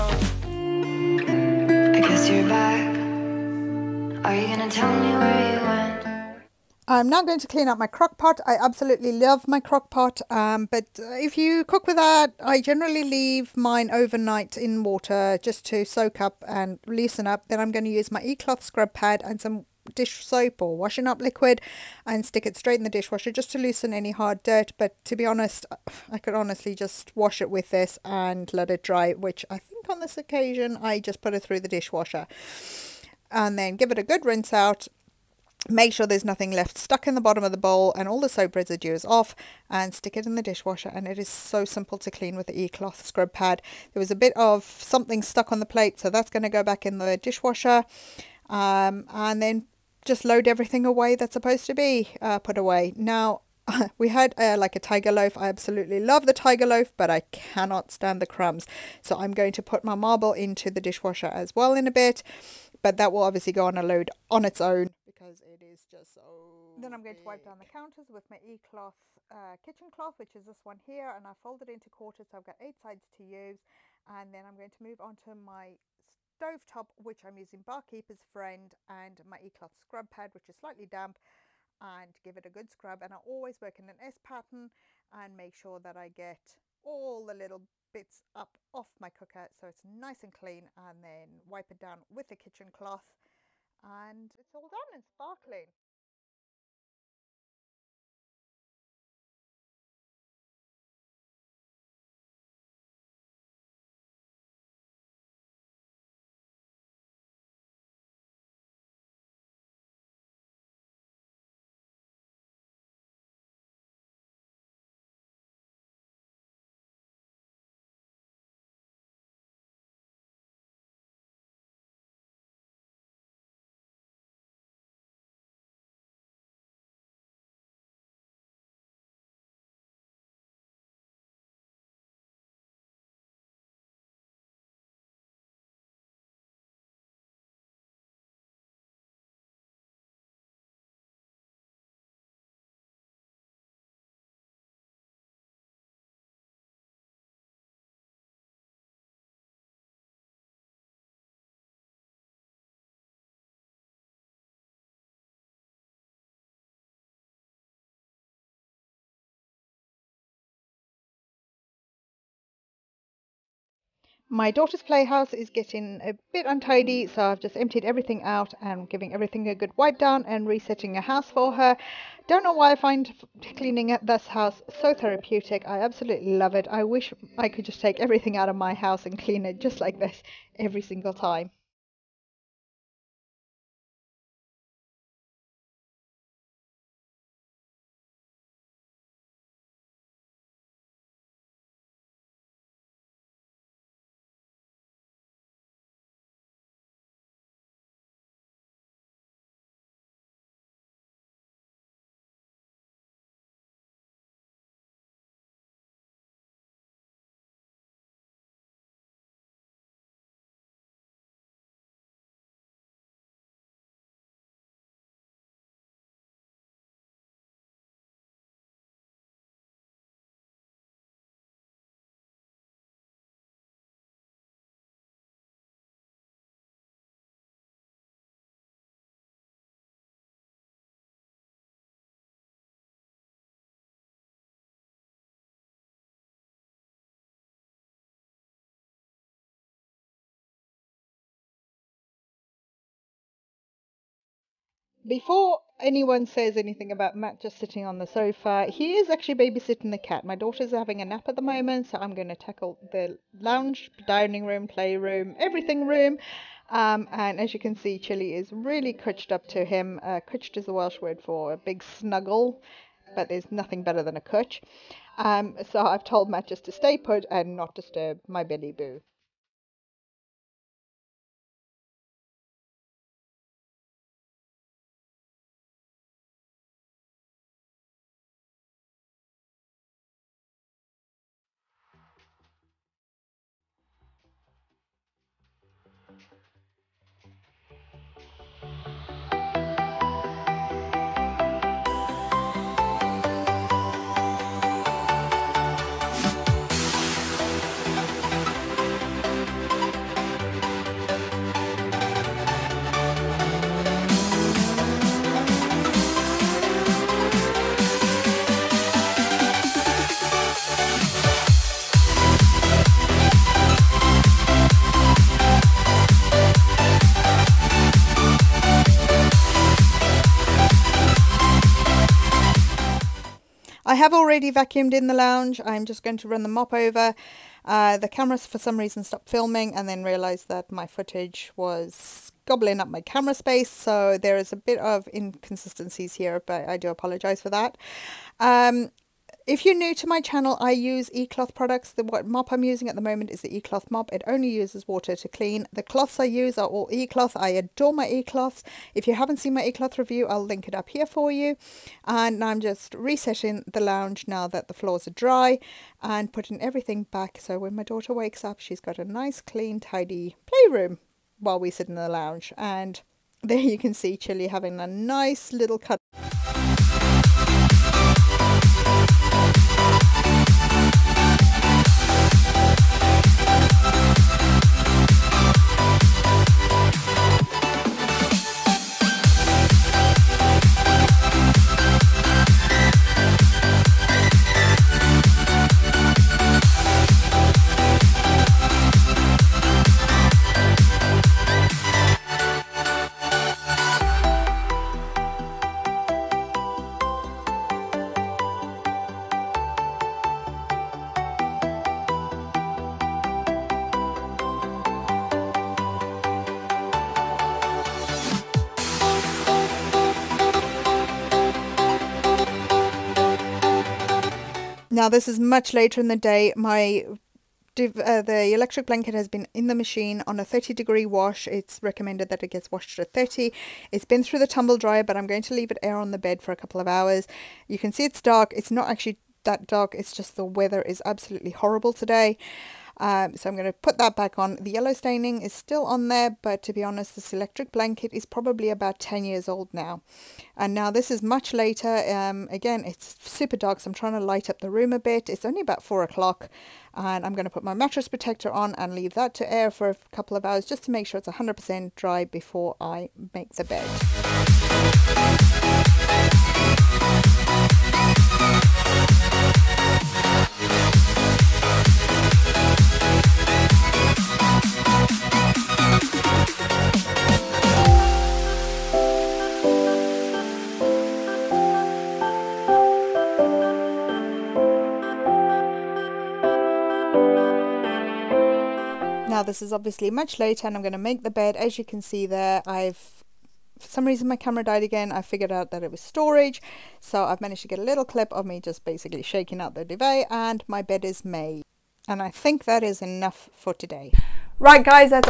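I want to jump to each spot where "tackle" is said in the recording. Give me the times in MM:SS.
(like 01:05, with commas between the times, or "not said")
04:12.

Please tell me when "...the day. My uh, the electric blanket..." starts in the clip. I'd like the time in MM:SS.
06:56.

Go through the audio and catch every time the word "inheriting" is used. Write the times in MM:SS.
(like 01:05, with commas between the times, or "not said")
not said.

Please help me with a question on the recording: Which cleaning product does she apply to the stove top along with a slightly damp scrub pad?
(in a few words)
Barkeeper's Friend.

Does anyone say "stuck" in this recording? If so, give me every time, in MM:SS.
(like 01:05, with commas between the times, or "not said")
00:36, 00:45.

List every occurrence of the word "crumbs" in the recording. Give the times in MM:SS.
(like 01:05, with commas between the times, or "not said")
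00:58.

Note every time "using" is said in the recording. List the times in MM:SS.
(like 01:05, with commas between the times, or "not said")
01:17, 05:42.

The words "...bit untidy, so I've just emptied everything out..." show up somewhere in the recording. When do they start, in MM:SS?
02:46.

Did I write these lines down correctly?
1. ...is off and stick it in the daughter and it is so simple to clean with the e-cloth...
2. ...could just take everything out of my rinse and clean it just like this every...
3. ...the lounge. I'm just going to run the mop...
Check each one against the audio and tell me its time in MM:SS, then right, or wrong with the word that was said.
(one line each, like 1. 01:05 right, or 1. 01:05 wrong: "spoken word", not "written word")
1. 00:38 wrong: "dishwasher", not "daughter"
2. 02:57 wrong: "house", not "rinse"
3. 05:25 right.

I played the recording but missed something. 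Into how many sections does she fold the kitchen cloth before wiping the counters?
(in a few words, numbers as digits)
Quarters.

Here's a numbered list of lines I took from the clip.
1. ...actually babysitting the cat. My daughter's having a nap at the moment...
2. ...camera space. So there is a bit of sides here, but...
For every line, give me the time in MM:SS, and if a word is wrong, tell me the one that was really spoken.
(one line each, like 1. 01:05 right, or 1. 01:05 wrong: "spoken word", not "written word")
1. 04:09 right
2. 05:32 wrong: "inconsistencies", not "sides".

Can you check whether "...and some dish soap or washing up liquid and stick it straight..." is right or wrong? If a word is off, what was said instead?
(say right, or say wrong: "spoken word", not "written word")
right.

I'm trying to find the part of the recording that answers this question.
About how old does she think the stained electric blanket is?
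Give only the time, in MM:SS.
07:18.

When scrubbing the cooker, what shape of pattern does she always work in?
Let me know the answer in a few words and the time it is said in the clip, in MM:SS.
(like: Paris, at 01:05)
S pattern, at 01:23.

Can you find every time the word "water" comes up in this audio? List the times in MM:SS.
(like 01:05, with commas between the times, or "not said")
00:14, 05:44.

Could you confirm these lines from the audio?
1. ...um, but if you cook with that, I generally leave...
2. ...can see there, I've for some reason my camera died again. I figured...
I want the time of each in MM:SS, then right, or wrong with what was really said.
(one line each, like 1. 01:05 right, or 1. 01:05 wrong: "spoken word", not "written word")
1. 00:10 right
2. 08:01 right.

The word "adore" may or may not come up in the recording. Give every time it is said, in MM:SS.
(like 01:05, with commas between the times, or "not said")
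05:47.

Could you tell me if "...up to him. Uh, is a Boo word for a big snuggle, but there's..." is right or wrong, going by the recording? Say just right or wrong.
wrong.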